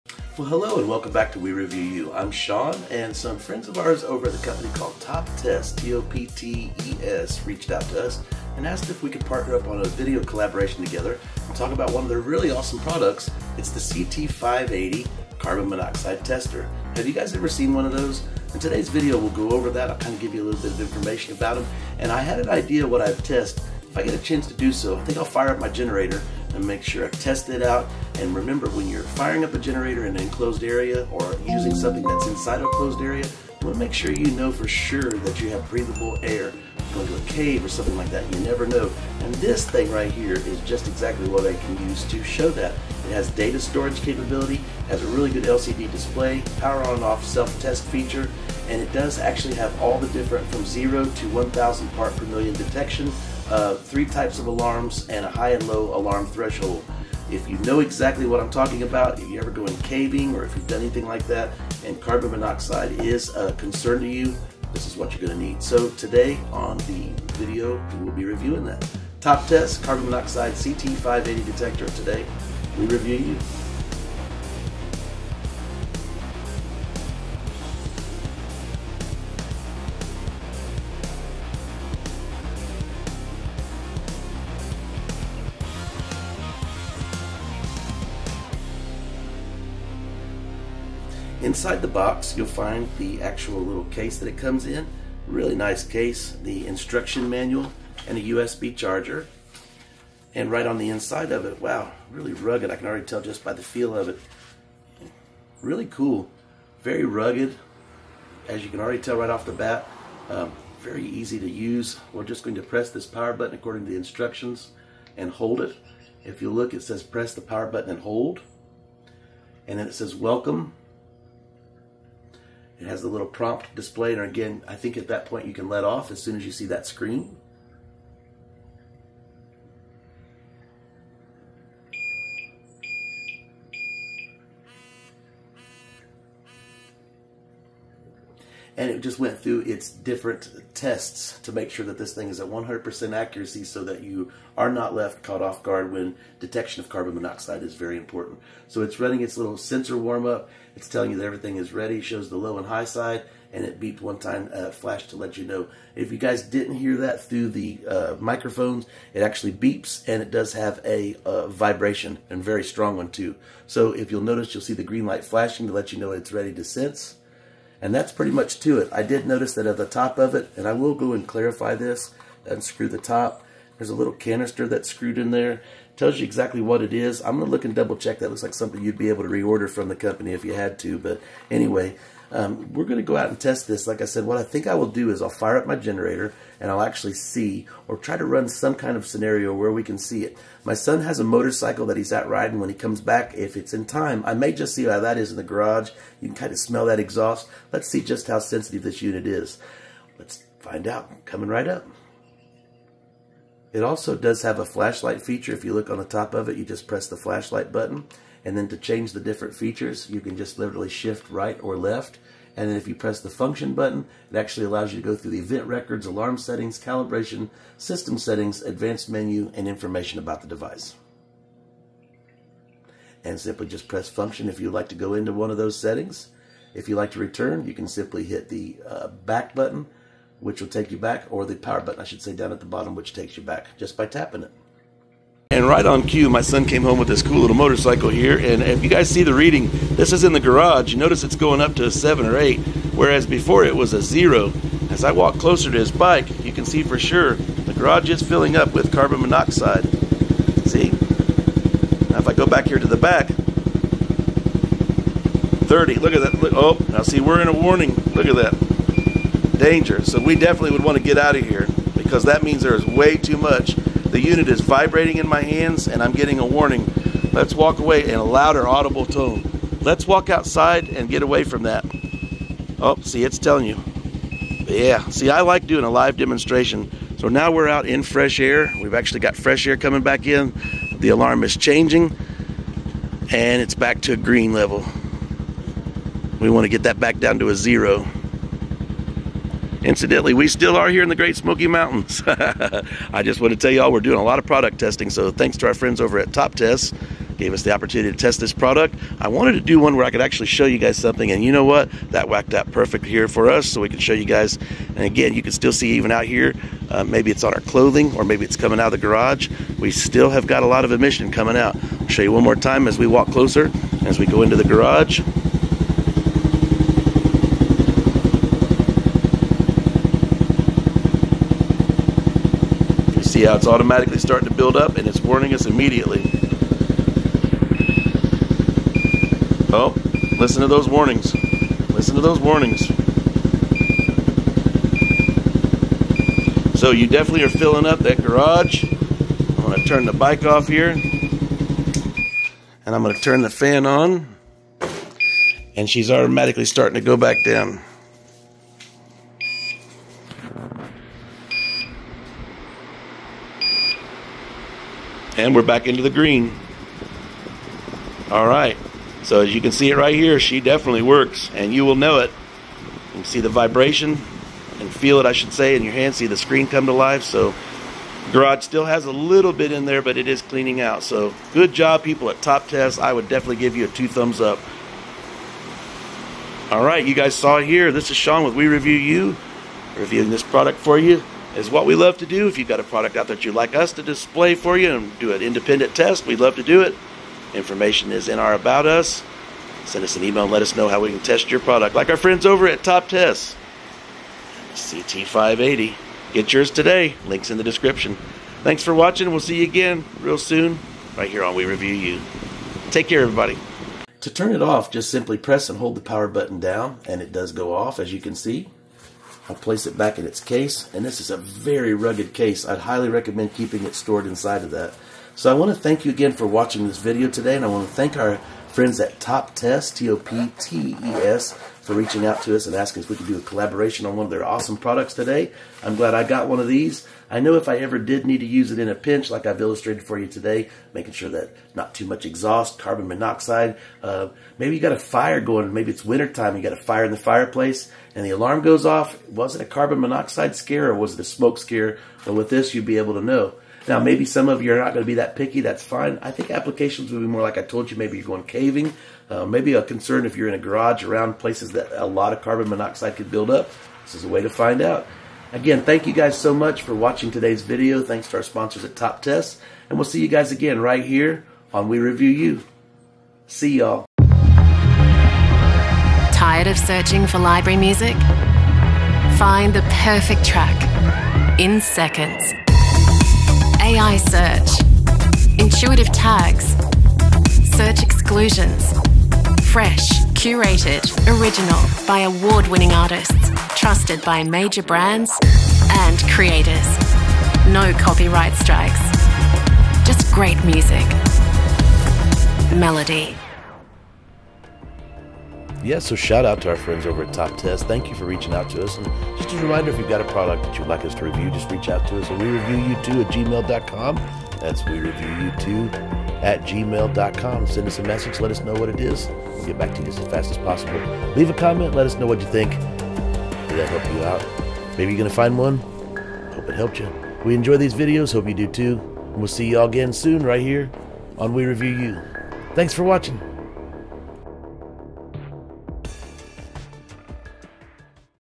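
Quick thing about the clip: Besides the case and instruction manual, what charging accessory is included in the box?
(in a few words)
USB charger.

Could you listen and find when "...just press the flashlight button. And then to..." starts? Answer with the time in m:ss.
3:26.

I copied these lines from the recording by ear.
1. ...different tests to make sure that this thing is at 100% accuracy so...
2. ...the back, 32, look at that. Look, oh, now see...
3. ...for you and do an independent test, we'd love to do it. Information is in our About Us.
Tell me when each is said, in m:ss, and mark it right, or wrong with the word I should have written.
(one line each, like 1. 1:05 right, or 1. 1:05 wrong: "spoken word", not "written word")
1. 2:19 right
2. 4:12 wrong: "30", not "32"
3. 6:24 right.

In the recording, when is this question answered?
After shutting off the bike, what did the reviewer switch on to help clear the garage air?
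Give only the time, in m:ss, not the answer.
5:43.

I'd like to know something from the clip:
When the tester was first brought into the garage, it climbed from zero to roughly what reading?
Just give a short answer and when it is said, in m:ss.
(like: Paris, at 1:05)
7 or 8, at 4:01.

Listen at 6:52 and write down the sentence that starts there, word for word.
I'd highly recommend keeping it stored inside of that.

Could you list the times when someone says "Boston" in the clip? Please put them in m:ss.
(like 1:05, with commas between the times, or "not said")
not said.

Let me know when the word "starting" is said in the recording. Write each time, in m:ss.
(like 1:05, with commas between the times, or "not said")
5:24, 5:46.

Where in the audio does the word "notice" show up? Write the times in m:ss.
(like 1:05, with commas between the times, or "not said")
2:44, 2:49, 4:00.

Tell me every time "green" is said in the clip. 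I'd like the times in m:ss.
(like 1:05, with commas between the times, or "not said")
2:44, 4:44, 5:56.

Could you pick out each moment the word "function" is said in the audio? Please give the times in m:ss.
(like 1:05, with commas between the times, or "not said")
3:33, 3:44.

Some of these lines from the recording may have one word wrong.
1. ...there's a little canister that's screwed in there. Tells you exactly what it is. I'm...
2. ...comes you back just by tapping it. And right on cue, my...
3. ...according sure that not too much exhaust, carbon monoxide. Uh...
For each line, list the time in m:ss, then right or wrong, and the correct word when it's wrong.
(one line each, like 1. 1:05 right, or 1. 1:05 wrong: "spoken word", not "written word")
1. 2:53 right
2. 3:53 wrong: "takes", not "comes"
3. 7:10 wrong: "making", not "according".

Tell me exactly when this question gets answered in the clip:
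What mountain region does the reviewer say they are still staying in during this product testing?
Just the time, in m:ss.
4:51.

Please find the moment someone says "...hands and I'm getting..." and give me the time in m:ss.
4:25.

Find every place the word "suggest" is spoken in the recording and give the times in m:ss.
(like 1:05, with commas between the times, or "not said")
not said.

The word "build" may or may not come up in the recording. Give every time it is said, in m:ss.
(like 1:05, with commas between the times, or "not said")
5:24, 7:33.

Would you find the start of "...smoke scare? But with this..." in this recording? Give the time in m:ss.
7:21.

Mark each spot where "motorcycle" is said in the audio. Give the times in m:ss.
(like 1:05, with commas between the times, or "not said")
3:11, 3:57.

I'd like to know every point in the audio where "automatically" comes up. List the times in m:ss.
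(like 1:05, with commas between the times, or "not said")
5:23, 5:46.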